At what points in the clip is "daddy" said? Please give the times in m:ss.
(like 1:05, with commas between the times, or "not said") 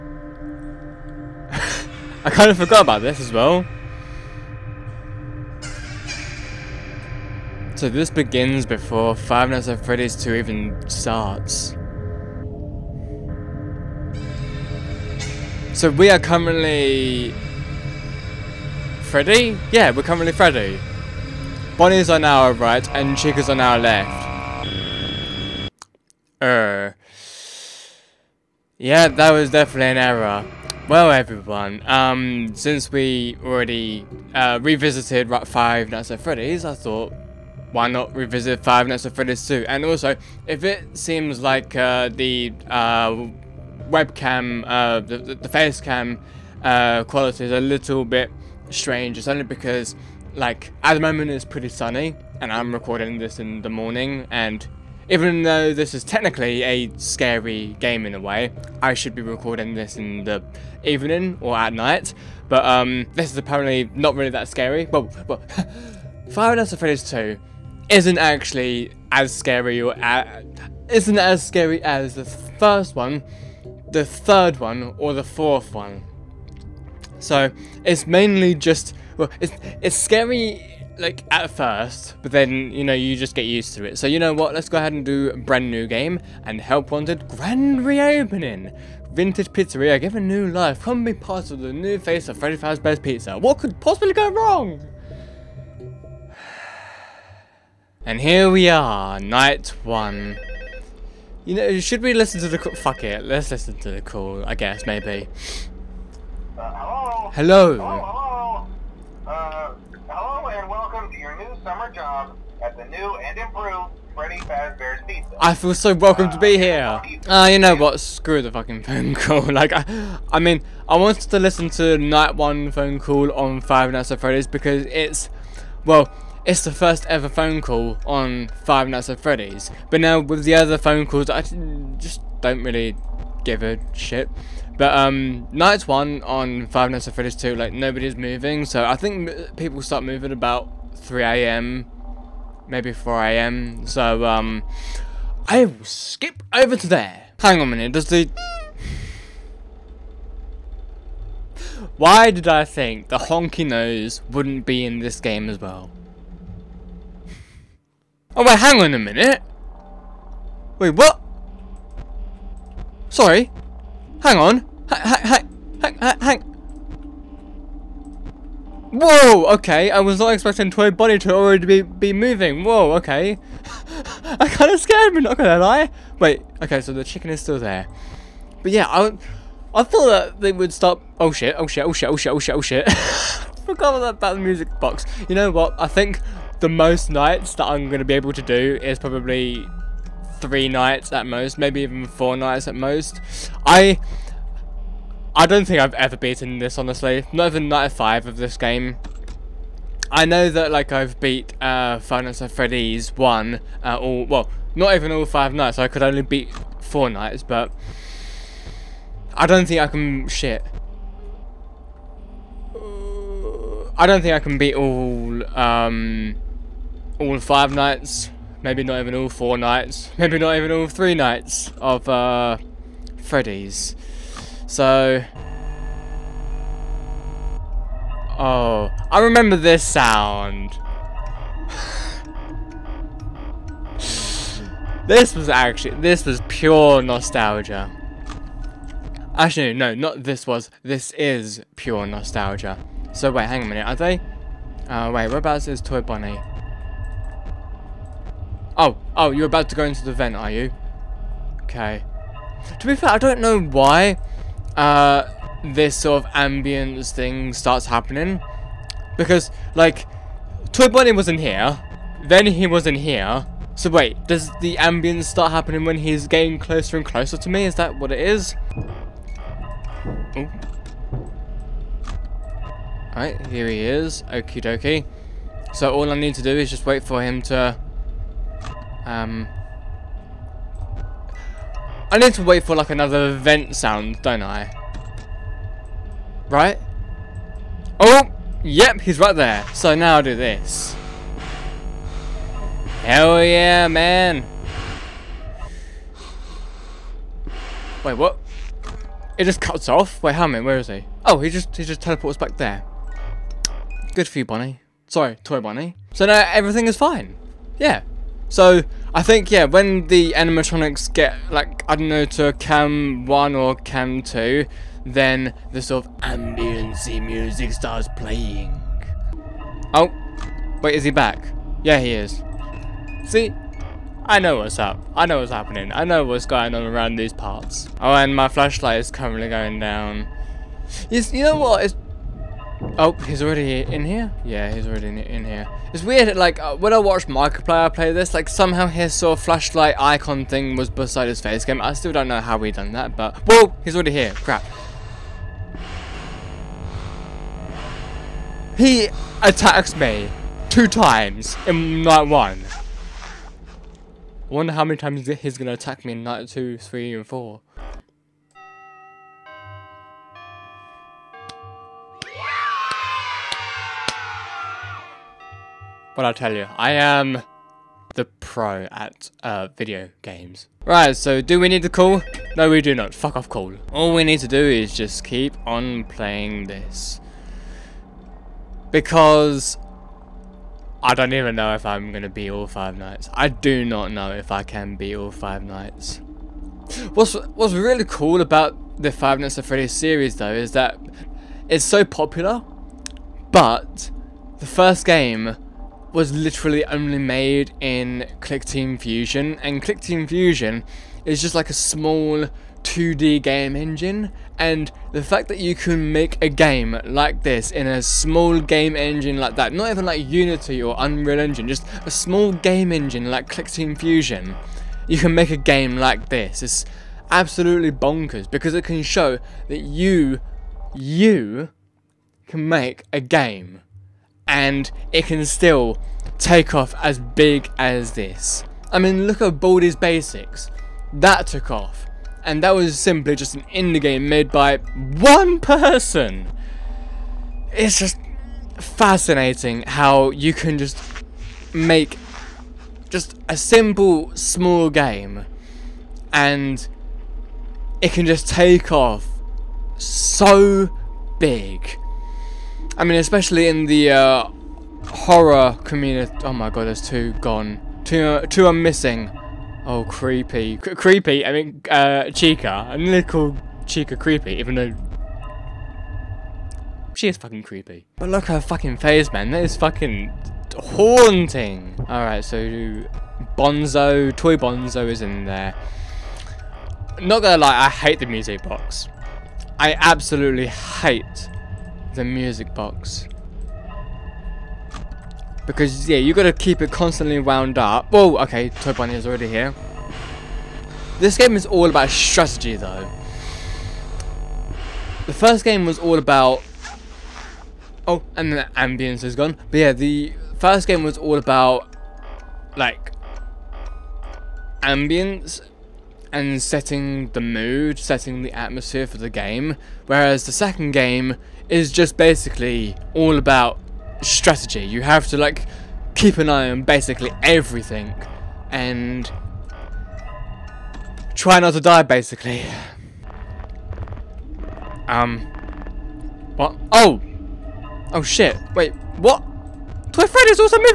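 not said.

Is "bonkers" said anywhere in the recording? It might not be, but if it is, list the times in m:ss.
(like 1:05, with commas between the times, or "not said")
6:57.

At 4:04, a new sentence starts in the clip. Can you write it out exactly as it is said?
Uh, wait, whereabouts is Toy Bunny?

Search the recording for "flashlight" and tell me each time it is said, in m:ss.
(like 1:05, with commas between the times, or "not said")
5:28, 5:39.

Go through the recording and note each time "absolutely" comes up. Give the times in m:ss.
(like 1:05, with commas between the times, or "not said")
6:57, 7:59.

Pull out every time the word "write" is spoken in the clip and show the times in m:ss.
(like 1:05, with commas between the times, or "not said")
not said.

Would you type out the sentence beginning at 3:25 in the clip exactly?
I could only beat four nights, but...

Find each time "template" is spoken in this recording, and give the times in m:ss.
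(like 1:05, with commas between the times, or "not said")
not said.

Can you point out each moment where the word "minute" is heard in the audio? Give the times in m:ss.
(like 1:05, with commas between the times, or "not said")
2:27, 2:38, 4:03.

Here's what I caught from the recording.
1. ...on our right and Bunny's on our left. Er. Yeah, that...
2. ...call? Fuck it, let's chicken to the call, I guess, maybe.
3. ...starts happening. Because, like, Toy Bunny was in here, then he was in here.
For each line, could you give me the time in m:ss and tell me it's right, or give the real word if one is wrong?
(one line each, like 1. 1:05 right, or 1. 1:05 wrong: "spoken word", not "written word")
1. 0:22 wrong: "Chica", not "Bunny"
2. 1:42 wrong: "listen", not "chicken"
3. 4:17 right.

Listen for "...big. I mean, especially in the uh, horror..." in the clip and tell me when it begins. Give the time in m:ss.
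7:31.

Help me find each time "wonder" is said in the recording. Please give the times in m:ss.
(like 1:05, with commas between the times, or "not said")
5:54.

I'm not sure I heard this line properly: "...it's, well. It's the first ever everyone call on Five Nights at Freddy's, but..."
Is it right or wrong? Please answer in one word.
wrong.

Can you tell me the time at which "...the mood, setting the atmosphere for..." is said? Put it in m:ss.
8:27.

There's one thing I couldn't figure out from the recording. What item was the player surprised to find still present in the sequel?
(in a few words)
The honky nose.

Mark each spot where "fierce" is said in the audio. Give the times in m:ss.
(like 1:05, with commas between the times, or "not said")
not said.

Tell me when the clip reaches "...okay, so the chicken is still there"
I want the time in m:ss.
2:56.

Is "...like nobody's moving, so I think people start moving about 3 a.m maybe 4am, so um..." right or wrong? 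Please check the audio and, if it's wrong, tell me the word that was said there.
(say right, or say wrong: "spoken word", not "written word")
right.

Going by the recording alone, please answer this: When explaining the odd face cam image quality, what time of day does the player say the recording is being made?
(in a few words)
Morning.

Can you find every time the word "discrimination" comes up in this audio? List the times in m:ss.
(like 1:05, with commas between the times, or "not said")
not said.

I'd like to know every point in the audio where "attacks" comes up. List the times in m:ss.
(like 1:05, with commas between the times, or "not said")
5:49, 5:55.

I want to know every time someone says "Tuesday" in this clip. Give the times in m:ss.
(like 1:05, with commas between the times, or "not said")
not said.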